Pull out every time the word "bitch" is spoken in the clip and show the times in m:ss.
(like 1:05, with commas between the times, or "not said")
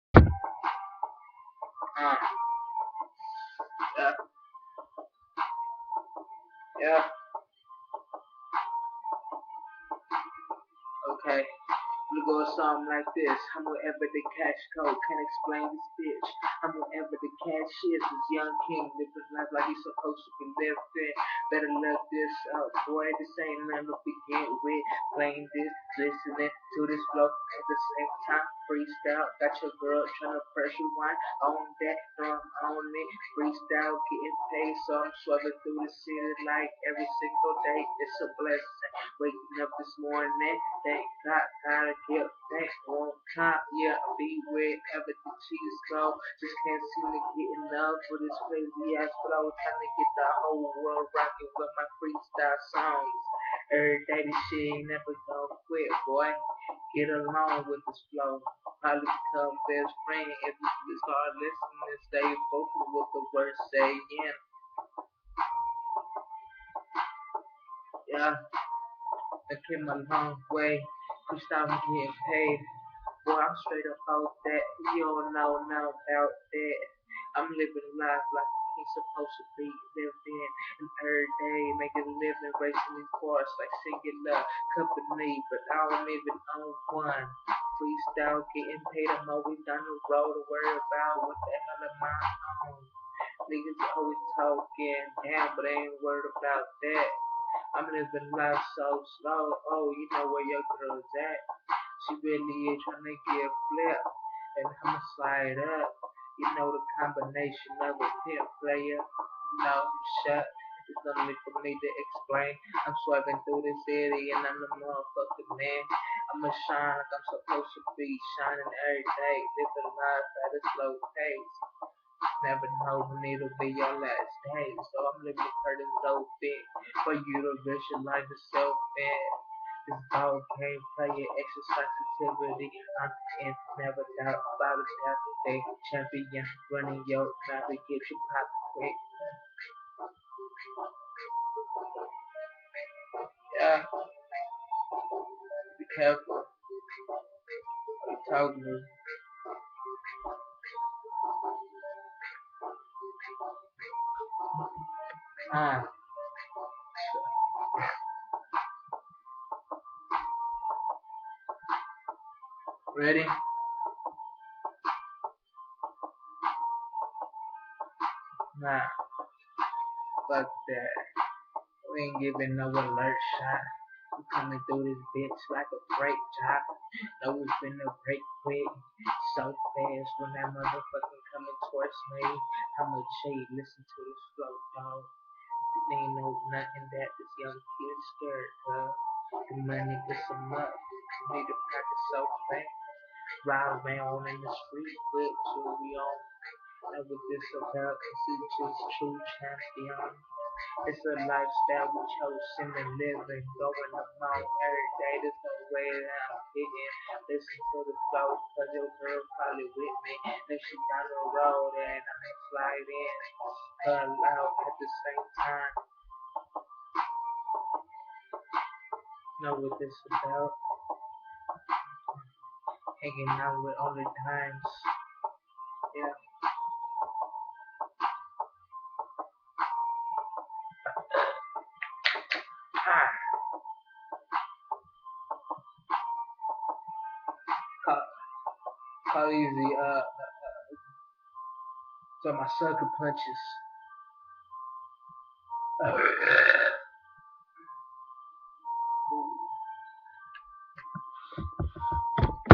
0:15, 2:55.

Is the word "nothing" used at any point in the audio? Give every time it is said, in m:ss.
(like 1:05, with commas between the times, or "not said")
0:23, 3:06.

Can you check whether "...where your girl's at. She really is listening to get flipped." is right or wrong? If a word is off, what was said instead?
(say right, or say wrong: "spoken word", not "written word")
wrong: "trying", not "listening".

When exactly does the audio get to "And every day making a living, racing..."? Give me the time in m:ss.
1:20.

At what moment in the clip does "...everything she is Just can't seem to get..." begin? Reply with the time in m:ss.
0:44.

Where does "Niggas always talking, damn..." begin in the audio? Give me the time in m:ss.
1:33.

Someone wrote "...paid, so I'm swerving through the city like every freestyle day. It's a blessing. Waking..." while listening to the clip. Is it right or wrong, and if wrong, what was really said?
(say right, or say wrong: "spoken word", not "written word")
wrong: "single", not "freestyle".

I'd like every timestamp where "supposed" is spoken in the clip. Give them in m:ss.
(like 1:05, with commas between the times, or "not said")
0:19, 1:18, 1:57.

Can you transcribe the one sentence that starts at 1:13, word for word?
Boy, I'm straight up out that.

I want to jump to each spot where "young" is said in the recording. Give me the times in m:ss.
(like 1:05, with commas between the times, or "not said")
0:18, 3:07.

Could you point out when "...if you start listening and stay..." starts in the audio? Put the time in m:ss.
1:00.